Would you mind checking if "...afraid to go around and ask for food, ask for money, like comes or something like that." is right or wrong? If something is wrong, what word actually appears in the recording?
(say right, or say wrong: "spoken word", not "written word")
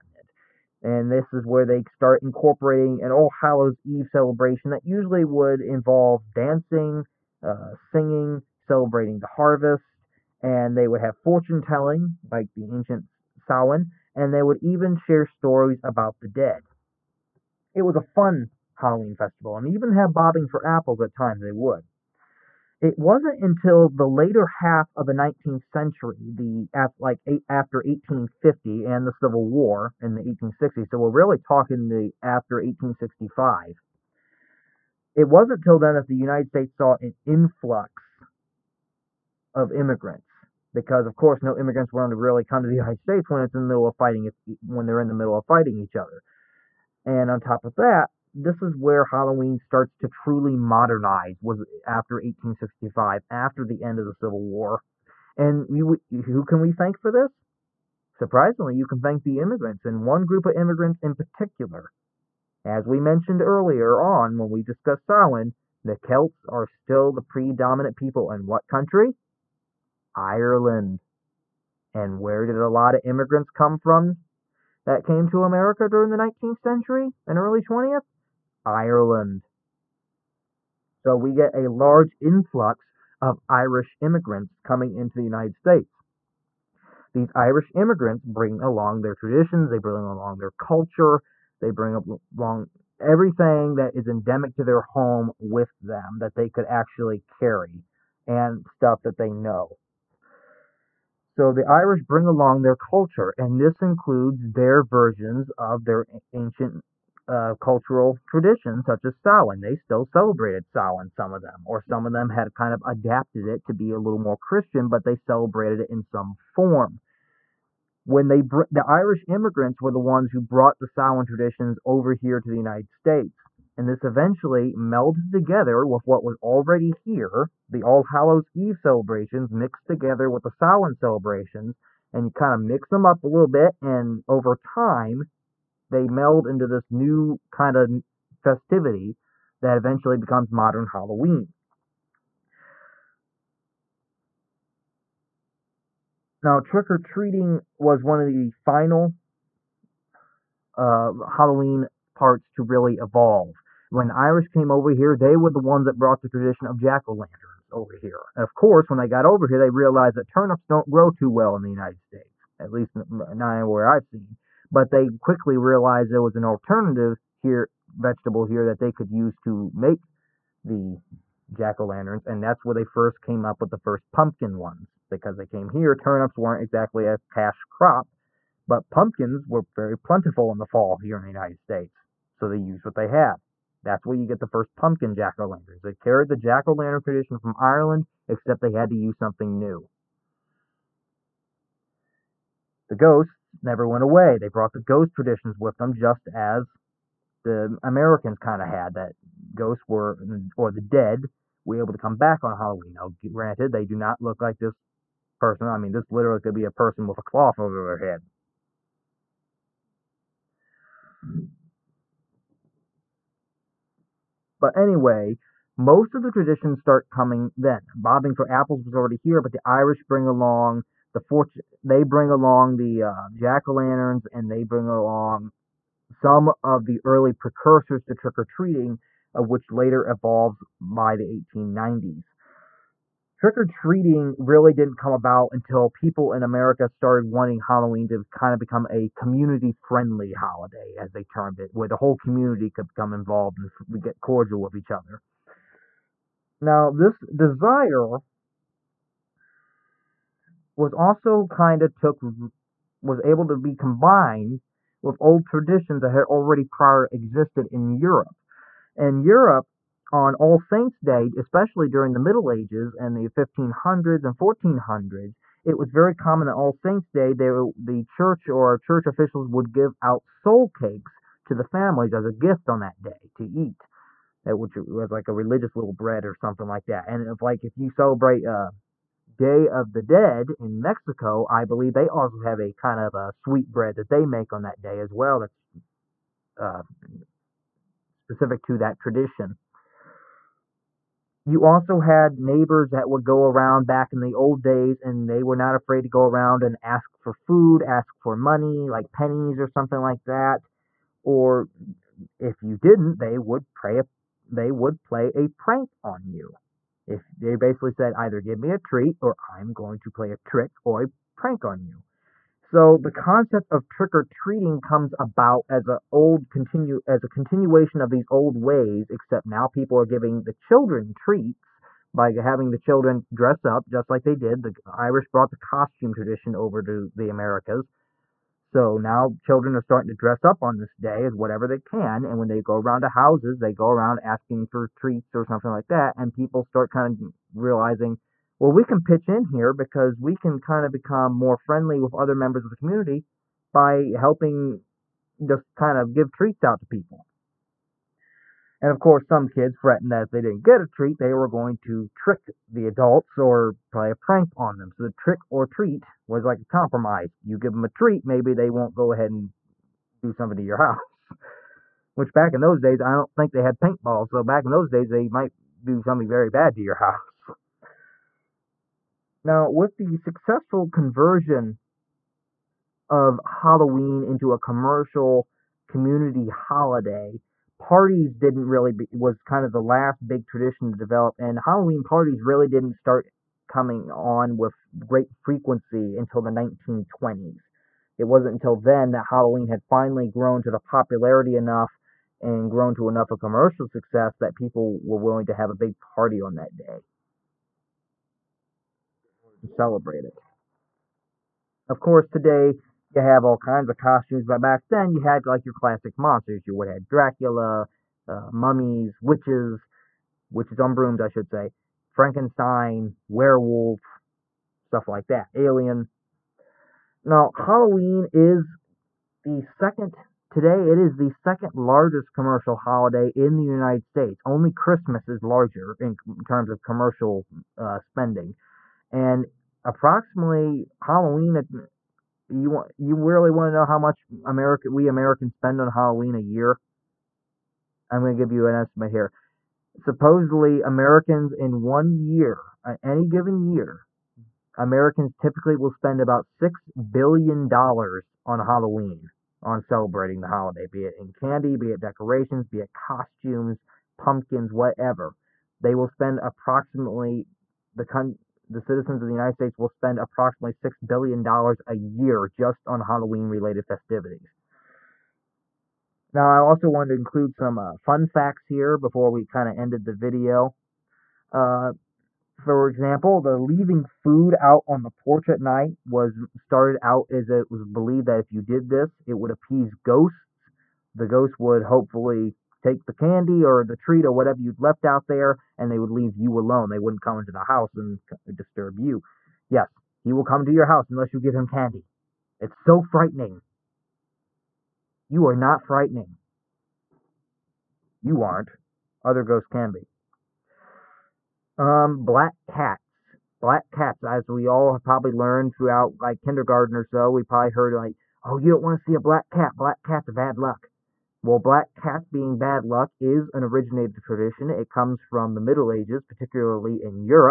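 wrong: "pennies", not "comes".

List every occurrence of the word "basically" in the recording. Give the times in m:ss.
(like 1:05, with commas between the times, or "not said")
5:07.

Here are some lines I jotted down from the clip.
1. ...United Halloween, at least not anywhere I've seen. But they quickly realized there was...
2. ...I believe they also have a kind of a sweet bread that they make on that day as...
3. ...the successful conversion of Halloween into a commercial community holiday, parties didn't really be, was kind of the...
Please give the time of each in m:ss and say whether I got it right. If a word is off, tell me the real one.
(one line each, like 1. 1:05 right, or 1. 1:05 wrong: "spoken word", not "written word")
1. 2:41 wrong: "States", not "Halloween"
2. 4:41 right
3. 6:09 right.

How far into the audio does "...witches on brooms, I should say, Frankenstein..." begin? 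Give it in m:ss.
6:50.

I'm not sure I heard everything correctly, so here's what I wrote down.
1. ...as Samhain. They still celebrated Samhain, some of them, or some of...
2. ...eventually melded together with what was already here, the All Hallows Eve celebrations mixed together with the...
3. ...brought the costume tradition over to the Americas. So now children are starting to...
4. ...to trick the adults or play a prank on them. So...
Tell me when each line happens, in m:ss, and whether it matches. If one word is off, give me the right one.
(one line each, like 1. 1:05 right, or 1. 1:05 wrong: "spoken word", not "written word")
1. 1:49 right
2. 2:04 right
3. 5:25 right
4. 5:51 right.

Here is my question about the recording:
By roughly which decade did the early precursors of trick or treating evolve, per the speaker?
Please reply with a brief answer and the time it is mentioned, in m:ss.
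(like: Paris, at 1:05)
1890s, at 3:51.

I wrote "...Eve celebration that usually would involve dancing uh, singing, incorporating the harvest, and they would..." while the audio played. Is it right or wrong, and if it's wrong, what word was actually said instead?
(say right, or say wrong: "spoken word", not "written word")
wrong: "celebrating", not "incorporating".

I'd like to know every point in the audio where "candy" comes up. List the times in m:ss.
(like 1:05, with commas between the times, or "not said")
7:31, 8:03, 8:11.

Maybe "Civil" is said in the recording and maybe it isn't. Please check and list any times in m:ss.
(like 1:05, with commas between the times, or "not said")
0:29, 0:54.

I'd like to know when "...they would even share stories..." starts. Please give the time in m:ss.
0:14.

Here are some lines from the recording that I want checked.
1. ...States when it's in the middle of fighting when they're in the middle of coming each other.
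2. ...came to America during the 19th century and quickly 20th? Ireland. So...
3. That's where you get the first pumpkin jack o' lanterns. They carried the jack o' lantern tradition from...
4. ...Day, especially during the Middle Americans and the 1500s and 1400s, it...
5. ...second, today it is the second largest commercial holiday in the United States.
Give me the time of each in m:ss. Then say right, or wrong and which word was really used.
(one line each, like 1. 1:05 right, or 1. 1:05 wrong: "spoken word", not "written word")
1. 0:42 wrong: "fighting", not "coming"
2. 1:15 wrong: "early", not "quickly"
3. 3:03 right
4. 4:21 wrong: "Ages", not "Americans"
5. 6:59 right.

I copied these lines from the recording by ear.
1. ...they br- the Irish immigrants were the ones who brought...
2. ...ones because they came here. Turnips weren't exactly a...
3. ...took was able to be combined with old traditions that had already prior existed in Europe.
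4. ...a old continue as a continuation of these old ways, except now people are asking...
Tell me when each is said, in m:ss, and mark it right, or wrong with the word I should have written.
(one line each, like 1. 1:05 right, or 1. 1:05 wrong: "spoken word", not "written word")
1. 1:58 right
2. 2:54 right
3. 4:11 right
4. 5:15 wrong: "giving", not "asking".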